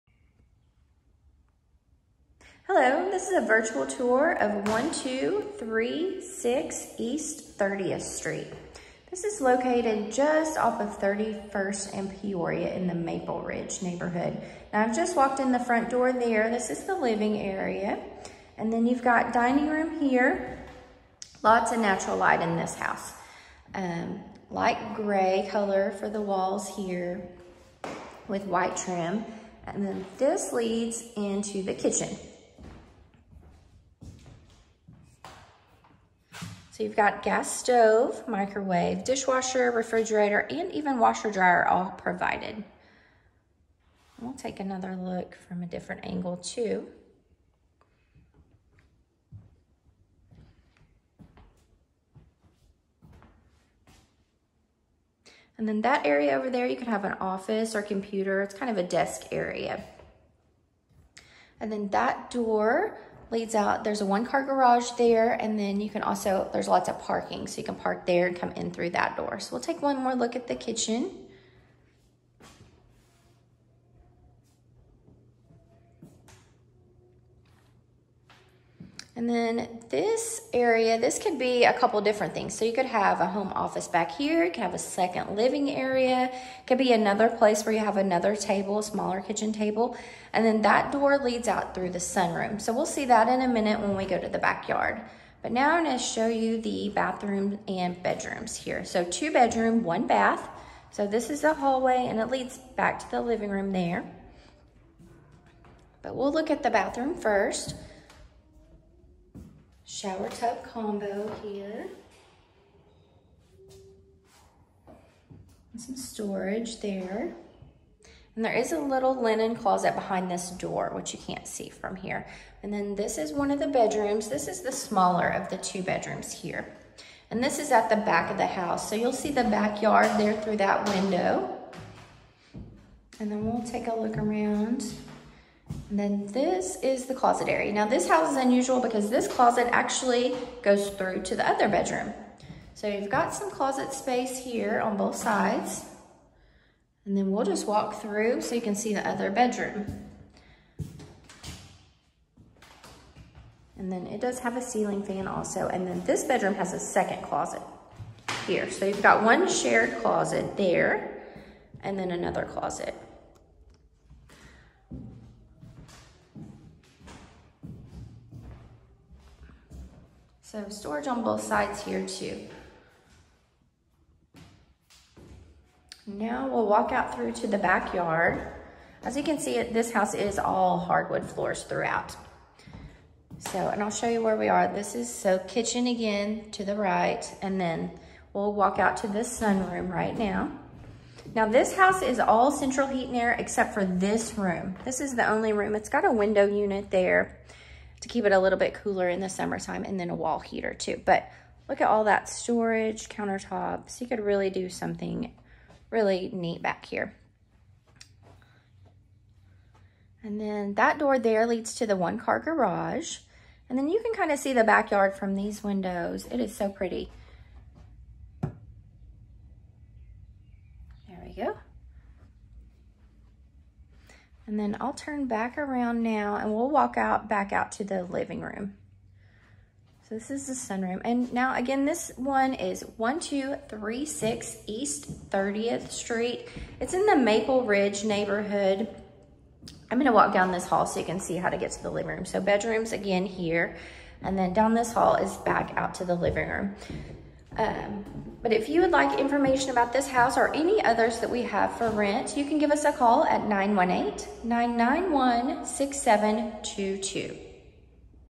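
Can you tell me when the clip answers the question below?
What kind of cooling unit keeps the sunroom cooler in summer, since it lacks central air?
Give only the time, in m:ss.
3:16.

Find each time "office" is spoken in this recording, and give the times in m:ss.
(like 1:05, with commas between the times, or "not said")
0:57, 1:23.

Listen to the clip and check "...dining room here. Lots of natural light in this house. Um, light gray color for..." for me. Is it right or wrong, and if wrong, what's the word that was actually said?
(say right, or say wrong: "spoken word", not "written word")
right.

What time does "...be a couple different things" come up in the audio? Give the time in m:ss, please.
1:21.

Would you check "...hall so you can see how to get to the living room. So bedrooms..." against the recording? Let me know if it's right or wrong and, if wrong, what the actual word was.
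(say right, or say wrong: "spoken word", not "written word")
right.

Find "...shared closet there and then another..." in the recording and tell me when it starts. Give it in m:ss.
2:39.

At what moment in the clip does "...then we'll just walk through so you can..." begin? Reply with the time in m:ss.
2:27.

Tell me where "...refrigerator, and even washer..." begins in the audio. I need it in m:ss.
0:39.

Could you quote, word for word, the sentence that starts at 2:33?
And then it does have a ceiling fan also.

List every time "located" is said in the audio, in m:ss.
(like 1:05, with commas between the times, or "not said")
0:09.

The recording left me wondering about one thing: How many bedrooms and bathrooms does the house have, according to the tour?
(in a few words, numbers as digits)
2 bedroom, 1 bath.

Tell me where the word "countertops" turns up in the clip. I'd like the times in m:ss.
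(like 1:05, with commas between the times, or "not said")
3:23.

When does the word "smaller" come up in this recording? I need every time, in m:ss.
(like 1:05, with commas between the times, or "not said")
1:28, 2:04.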